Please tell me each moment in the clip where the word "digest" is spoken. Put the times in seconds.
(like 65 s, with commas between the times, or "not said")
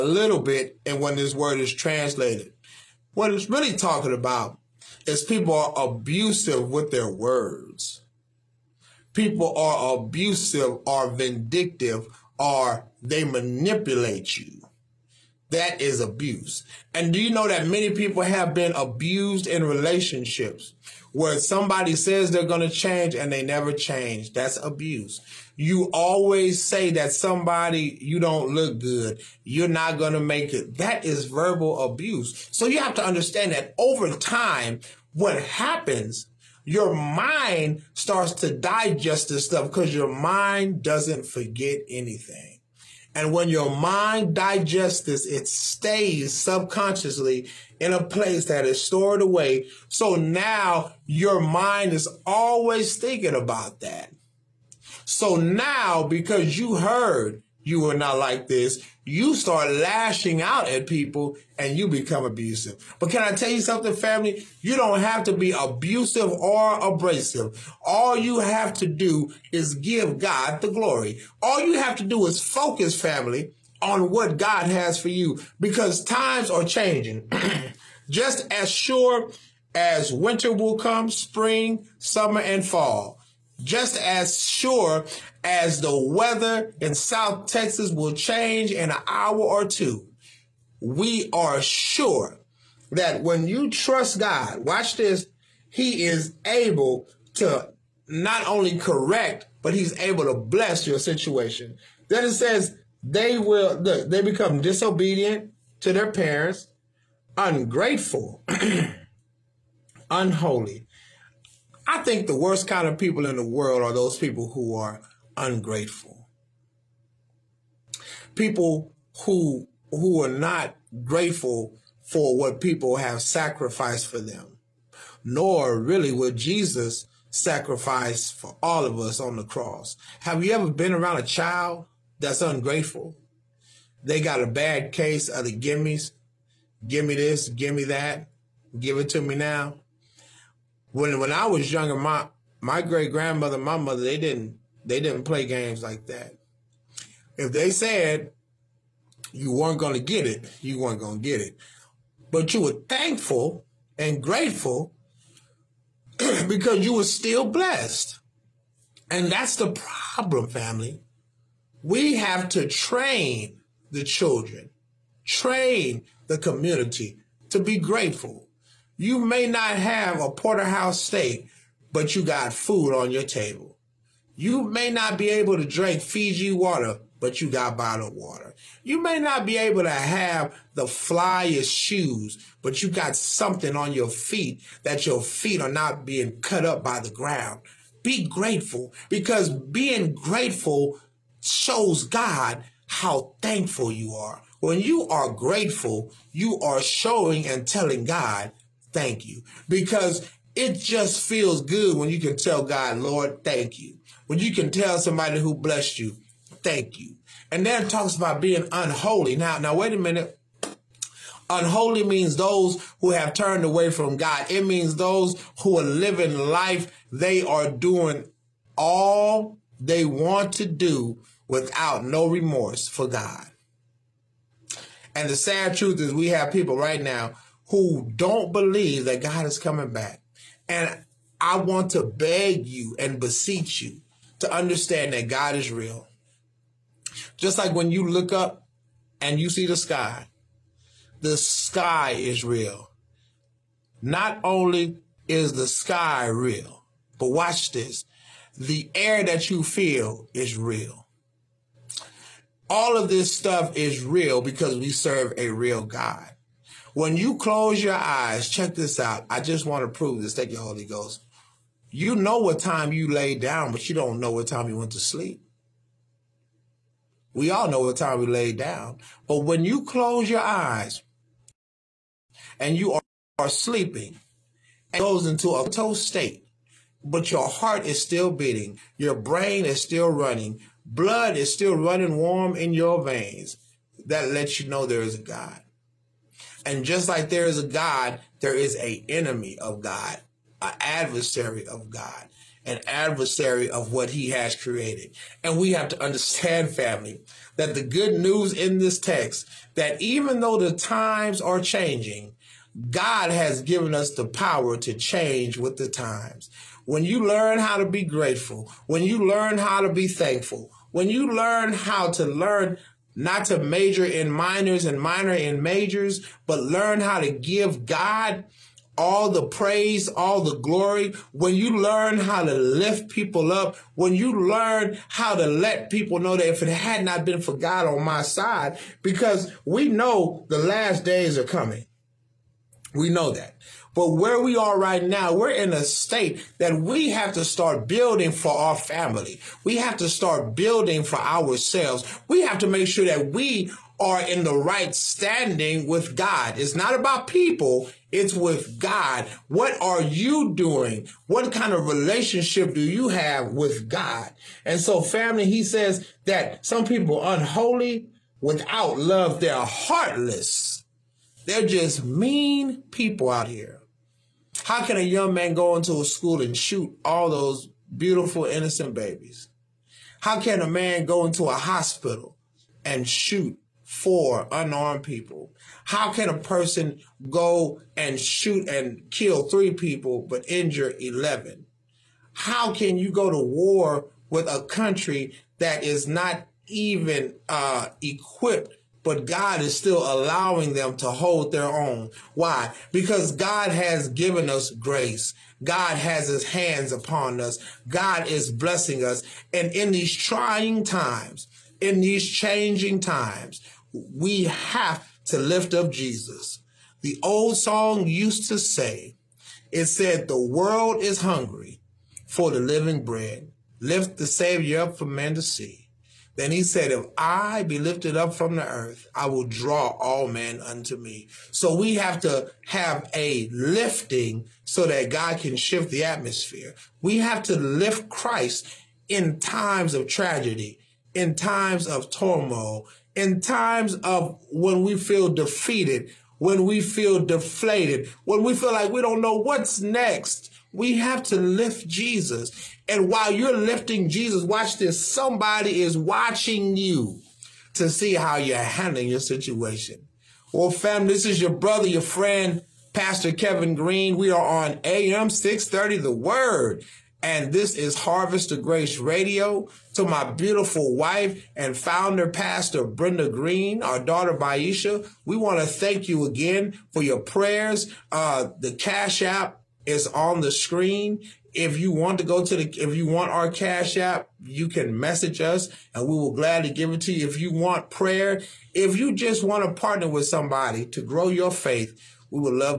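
38 s, 44 s.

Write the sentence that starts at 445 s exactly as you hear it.
Somebody is watching you to see how you're handling your situation.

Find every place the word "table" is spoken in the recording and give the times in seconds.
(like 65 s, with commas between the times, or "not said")
173 s.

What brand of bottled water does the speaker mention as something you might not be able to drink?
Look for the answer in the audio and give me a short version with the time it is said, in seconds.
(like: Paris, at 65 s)
Fiji water, at 175 s.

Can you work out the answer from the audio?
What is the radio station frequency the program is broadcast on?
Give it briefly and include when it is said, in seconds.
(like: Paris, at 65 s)
AM 630, at 454 s.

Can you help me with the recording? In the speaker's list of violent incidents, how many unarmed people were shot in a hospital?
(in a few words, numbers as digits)
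4.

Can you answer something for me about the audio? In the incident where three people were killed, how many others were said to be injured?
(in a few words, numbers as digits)
11.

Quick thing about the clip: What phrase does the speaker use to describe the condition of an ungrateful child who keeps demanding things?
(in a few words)
the gimmies.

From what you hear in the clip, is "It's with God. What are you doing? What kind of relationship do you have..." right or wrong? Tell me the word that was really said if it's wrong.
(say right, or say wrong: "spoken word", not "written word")
right.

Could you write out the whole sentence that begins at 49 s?
So now your mind is always thinking about that.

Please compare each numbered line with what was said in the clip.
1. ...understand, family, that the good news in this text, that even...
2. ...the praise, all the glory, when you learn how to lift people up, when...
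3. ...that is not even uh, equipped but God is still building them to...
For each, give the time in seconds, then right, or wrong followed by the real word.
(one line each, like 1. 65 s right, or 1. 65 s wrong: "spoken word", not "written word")
1. 296 s right
2. 319 s right
3. 385 s wrong: "allowing", not "building".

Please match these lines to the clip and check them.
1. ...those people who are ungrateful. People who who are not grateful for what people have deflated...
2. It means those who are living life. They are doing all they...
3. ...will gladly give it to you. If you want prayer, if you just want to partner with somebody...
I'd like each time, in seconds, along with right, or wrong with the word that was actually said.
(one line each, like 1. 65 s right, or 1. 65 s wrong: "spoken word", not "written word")
1. 113 s wrong: "sacrificed", not "deflated"
2. 214 s right
3. 476 s right.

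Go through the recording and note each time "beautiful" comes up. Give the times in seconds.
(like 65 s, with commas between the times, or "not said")
367 s, 460 s.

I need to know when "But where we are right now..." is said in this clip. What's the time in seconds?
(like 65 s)
333 s.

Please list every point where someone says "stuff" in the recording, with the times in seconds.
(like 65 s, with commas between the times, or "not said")
39 s, 253 s.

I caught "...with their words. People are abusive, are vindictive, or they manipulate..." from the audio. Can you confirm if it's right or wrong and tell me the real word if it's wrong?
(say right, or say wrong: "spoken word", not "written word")
right.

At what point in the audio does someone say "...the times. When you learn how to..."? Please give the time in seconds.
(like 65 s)
305 s.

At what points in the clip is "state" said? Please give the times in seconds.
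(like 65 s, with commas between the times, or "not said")
275 s, 335 s.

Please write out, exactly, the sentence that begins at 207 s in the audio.
And then it talks about being unholy.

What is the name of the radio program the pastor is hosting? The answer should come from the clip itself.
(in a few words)
Harvest of Grace Radio.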